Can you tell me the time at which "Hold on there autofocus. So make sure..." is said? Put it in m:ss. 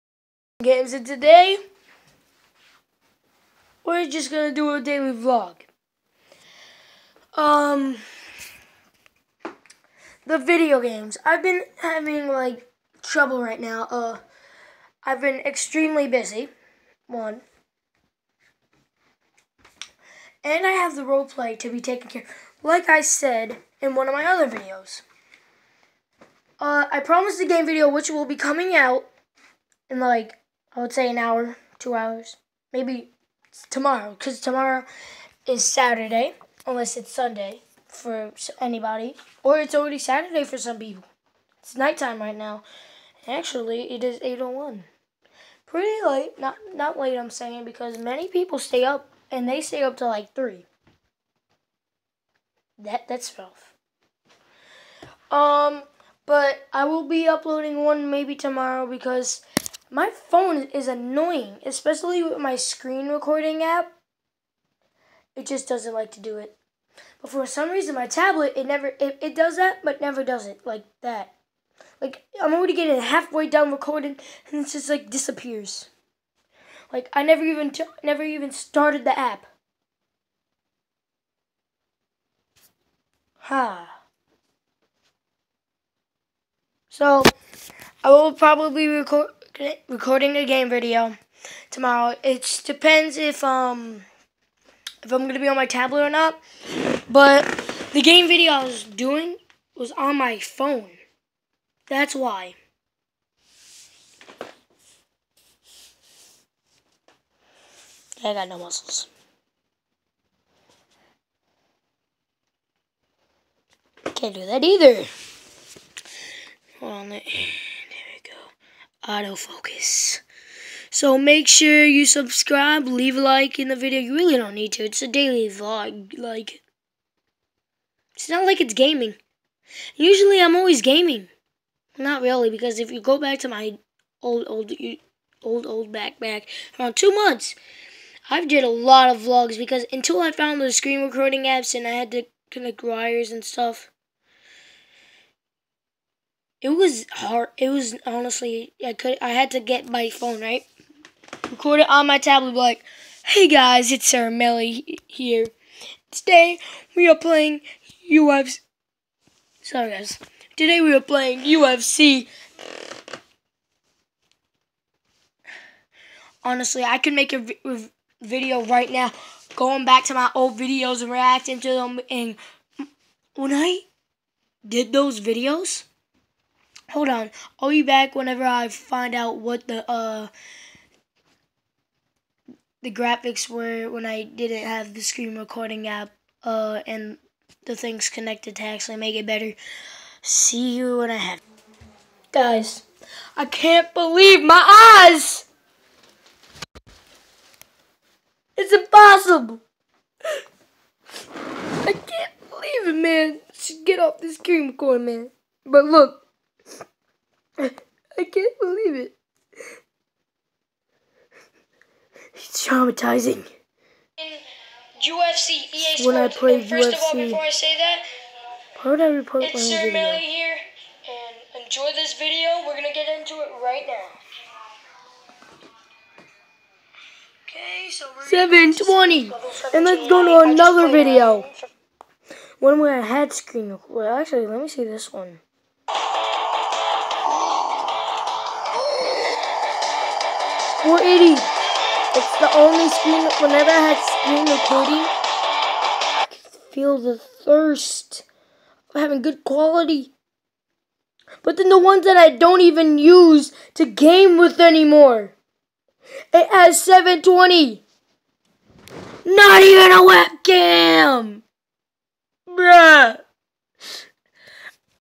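1:56.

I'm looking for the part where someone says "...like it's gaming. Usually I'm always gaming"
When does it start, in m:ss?
2:08.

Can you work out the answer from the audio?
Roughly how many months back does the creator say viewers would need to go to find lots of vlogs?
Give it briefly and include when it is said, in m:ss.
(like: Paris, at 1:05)
2 months, at 2:16.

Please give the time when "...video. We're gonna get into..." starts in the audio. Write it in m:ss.
3:42.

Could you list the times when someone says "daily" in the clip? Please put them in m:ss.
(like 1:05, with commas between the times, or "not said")
0:04, 2:05.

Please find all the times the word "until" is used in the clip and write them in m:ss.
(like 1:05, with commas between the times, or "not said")
2:19.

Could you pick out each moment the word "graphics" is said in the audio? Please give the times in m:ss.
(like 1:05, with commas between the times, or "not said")
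3:02.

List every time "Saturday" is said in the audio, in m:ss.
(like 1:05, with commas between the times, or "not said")
0:35, 0:39.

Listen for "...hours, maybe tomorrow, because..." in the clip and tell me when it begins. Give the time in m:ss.
0:31.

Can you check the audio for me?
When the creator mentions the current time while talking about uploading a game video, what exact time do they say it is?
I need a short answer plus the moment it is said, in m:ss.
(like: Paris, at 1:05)
8:01, at 0:44.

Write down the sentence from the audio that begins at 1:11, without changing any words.
Like, I'm already getting halfway done recording, and it just like disappears.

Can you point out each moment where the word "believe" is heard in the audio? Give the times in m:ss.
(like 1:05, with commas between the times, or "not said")
3:13, 3:22.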